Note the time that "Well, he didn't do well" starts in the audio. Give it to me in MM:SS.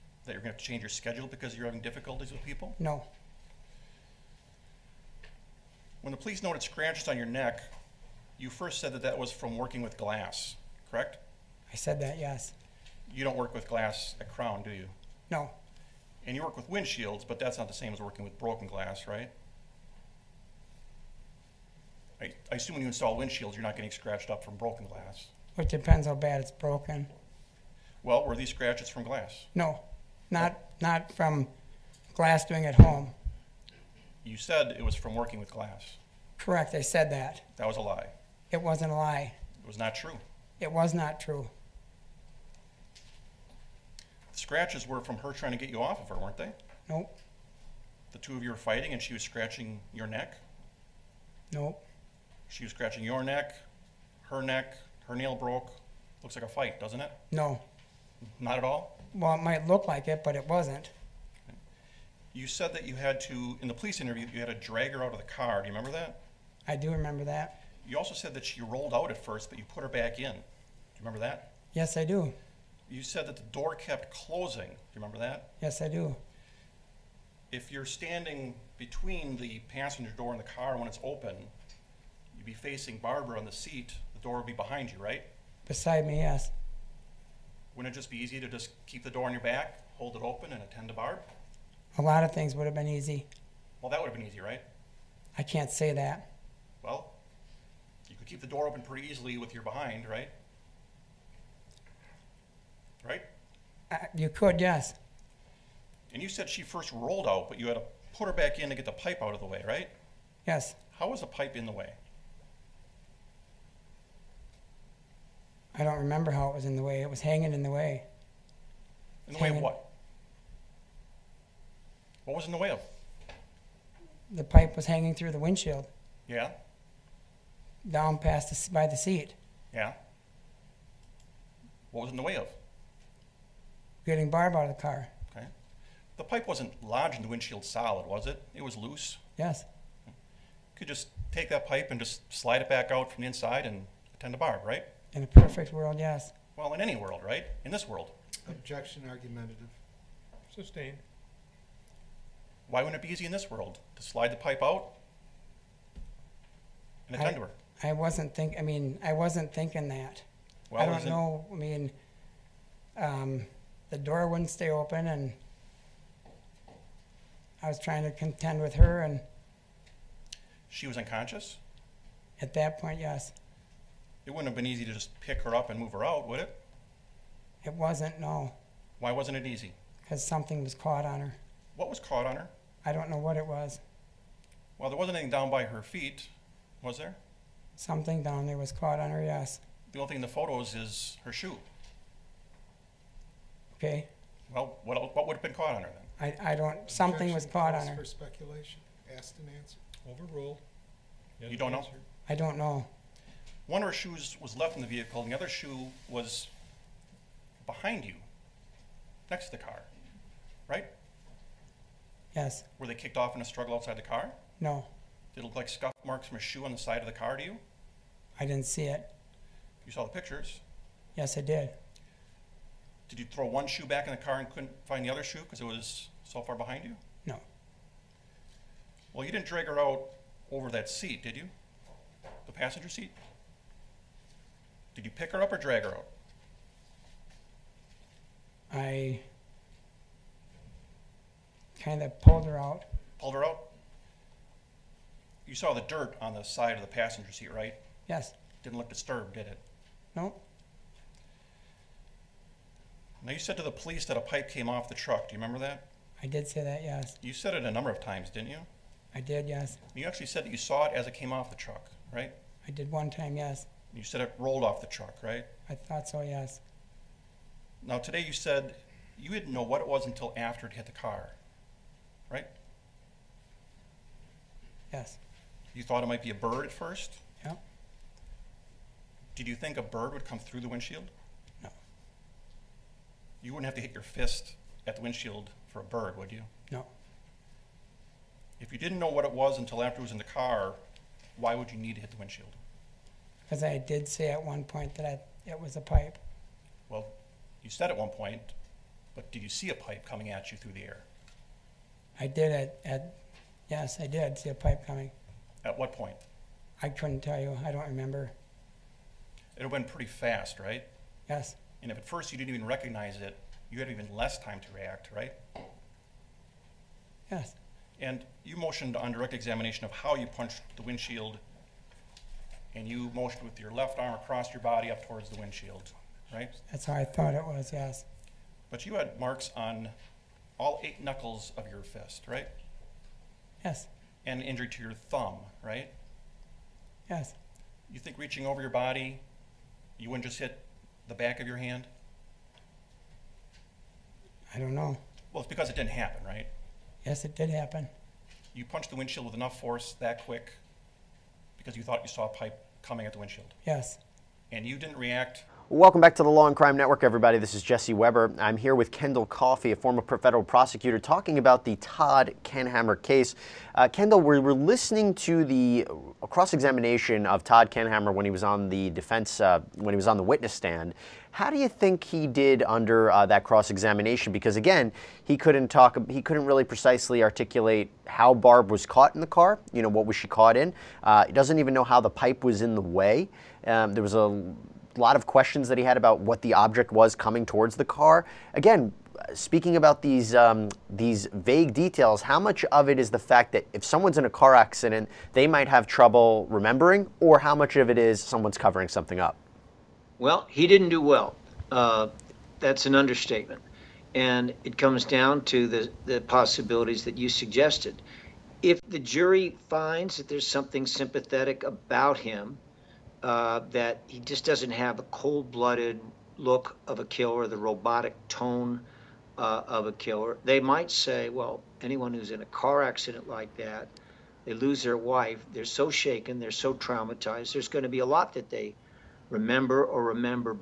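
06:40.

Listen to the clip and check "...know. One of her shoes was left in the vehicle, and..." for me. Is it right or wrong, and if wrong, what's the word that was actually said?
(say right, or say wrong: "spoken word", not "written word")
right.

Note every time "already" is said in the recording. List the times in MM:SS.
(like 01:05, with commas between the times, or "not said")
not said.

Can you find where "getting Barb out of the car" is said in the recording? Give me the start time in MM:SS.
02:14.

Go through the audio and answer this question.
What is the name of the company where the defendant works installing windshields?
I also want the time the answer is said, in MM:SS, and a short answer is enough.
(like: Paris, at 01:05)
Crown, at 00:14.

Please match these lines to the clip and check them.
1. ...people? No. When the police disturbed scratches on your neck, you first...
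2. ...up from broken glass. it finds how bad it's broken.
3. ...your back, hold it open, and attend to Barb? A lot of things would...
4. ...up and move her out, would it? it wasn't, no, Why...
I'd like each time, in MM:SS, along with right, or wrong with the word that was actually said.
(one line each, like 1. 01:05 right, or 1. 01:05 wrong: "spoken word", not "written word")
1. 00:02 wrong: "noted", not "disturbed"
2. 00:24 wrong: "depends", not "finds"
3. 01:29 right
4. 02:55 right.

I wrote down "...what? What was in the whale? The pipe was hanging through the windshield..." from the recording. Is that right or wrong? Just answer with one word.
right.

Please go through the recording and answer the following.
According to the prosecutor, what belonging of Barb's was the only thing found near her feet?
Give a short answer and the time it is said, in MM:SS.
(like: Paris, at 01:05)
Her shoe, at 03:11.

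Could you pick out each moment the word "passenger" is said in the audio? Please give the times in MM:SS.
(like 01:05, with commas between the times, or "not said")
01:19, 03:52, 04:06.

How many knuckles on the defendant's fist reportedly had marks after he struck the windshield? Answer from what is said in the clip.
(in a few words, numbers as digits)
8.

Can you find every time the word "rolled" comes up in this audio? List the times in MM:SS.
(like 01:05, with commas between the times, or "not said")
01:08, 01:46, 04:24.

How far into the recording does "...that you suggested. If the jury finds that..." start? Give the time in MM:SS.
06:47.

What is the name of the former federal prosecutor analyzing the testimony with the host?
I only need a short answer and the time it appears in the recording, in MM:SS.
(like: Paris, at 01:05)
Kendall Coffey, at 05:58.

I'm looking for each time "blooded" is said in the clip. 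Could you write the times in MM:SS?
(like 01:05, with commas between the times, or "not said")
06:55.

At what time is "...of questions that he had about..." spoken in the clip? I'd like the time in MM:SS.
06:25.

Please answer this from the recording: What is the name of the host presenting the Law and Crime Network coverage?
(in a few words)
Jesse Weber.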